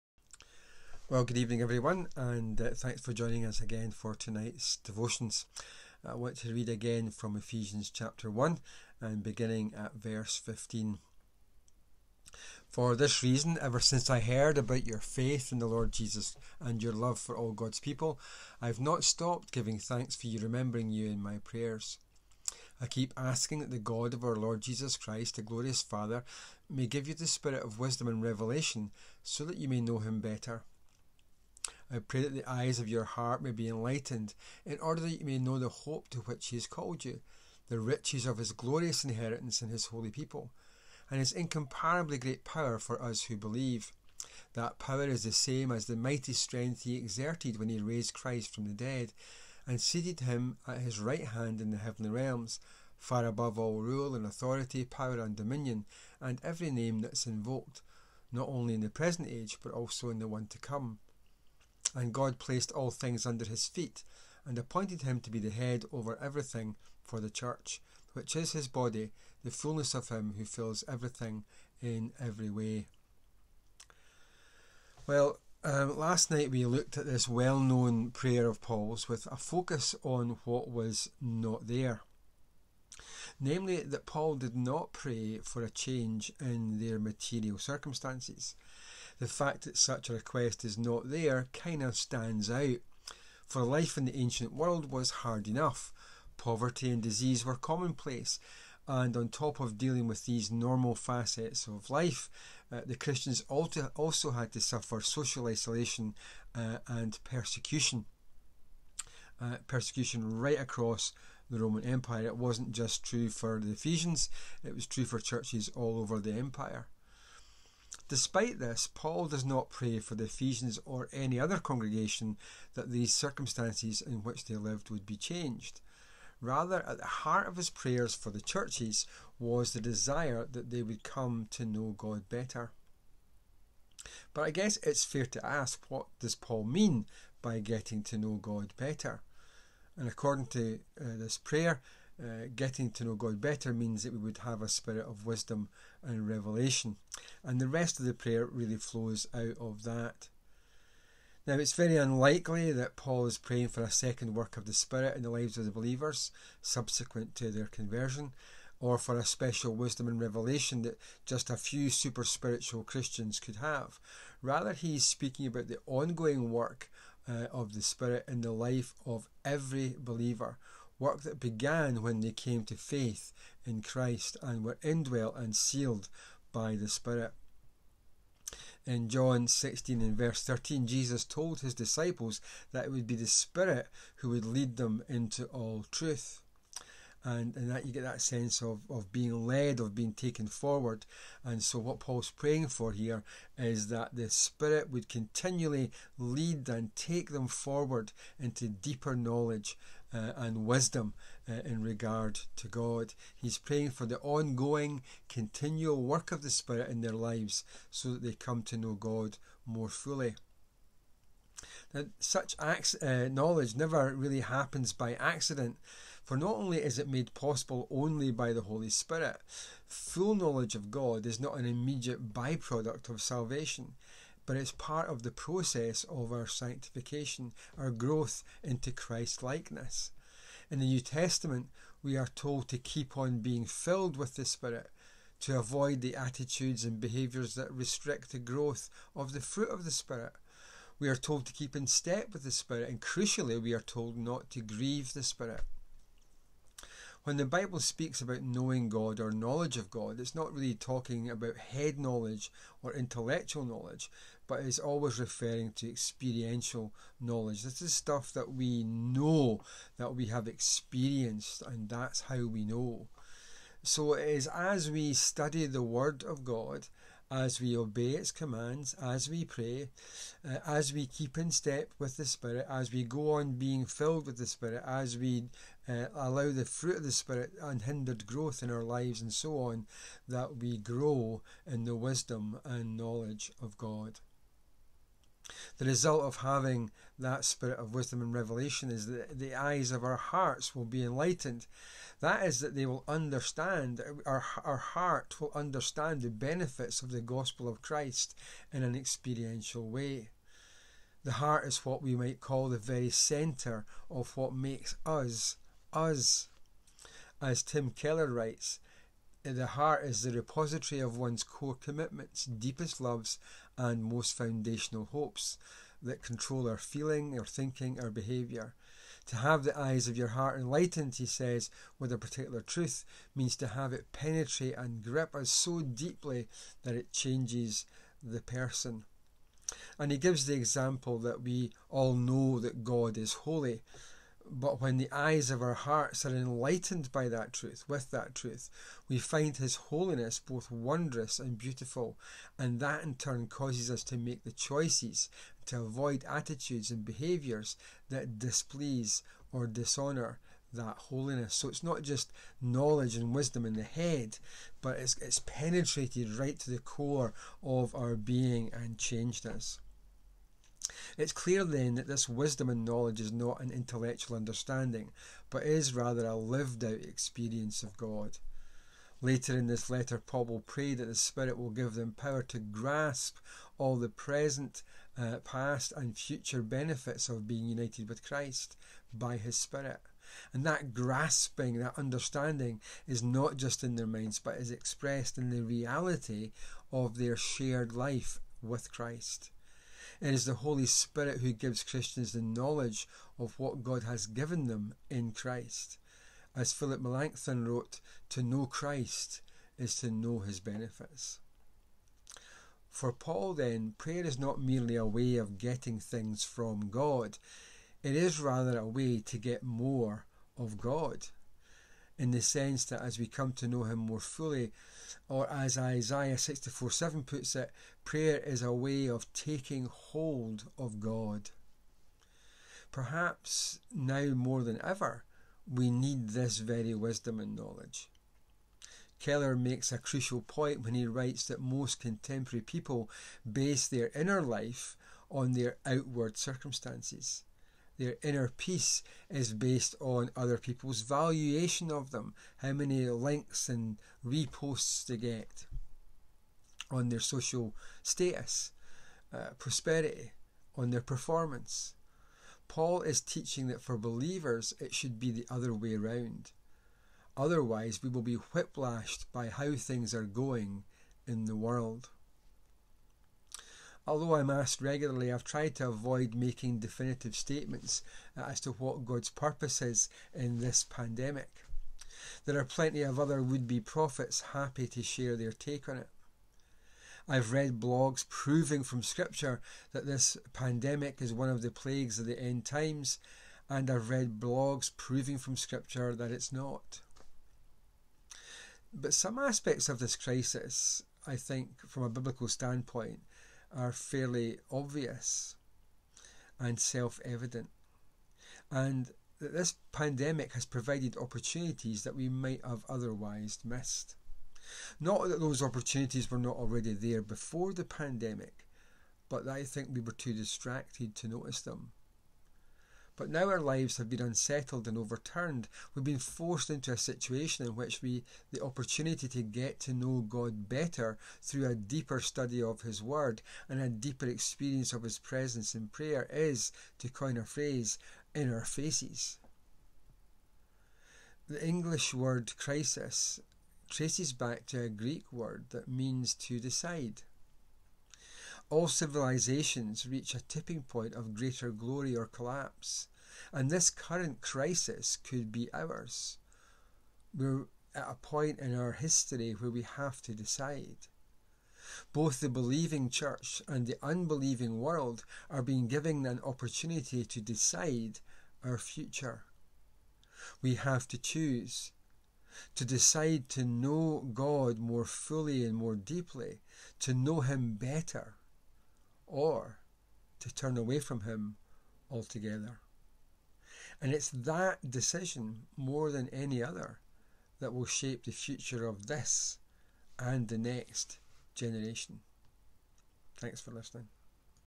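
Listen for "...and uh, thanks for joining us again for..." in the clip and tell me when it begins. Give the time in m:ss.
0:02.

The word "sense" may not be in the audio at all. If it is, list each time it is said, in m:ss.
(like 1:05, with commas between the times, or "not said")
3:08, 6:52.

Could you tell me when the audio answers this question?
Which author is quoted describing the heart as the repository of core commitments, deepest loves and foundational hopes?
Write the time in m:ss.
5:07.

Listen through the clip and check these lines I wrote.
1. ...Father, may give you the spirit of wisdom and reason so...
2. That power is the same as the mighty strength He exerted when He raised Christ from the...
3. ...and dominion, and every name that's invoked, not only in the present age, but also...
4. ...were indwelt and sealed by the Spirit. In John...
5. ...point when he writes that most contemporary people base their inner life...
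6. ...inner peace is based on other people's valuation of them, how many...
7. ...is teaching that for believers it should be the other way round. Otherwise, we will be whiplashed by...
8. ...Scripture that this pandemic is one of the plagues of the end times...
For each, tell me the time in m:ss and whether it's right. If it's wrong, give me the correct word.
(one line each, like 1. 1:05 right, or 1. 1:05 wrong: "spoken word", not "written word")
1. 0:25 wrong: "revelation", not "reason"
2. 0:44 right
3. 0:55 right
4. 2:54 right
5. 7:10 right
6. 7:18 right
7. 7:33 right
8. 7:59 right.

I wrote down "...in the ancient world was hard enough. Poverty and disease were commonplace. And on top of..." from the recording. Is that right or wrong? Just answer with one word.
right.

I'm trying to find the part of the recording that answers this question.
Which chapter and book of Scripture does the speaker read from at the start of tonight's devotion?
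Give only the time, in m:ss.
0:07.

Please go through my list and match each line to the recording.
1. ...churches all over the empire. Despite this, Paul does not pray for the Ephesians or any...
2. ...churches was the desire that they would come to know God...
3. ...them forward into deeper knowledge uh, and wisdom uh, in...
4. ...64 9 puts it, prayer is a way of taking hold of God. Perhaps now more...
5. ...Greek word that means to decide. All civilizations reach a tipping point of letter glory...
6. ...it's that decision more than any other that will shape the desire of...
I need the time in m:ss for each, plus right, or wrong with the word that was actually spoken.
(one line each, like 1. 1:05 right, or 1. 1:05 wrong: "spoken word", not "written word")
1. 1:55 right
2. 2:08 right
3. 3:17 right
4. 6:56 wrong: "7", not "9"
5. 8:54 wrong: "greater", not "letter"
6. 9:34 wrong: "future", not "desire".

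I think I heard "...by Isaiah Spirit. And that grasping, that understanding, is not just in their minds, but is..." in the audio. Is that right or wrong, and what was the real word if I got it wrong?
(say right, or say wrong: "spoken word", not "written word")
wrong: "His", not "Isaiah".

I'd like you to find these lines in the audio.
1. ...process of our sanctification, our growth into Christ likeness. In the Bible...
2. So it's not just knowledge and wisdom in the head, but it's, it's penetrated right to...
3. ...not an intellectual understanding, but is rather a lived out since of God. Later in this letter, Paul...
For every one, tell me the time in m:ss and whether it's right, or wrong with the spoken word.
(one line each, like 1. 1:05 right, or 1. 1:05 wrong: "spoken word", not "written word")
1. 3:45 wrong: "New", not "Bible"
2. 5:51 right
3. 6:03 wrong: "experience", not "since".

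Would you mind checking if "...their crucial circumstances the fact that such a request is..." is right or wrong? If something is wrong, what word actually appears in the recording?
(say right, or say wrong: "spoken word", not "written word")
wrong: "material", not "crucial".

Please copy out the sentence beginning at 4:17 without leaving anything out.
This is stuff that we know, that we have experienced, and that's how we know.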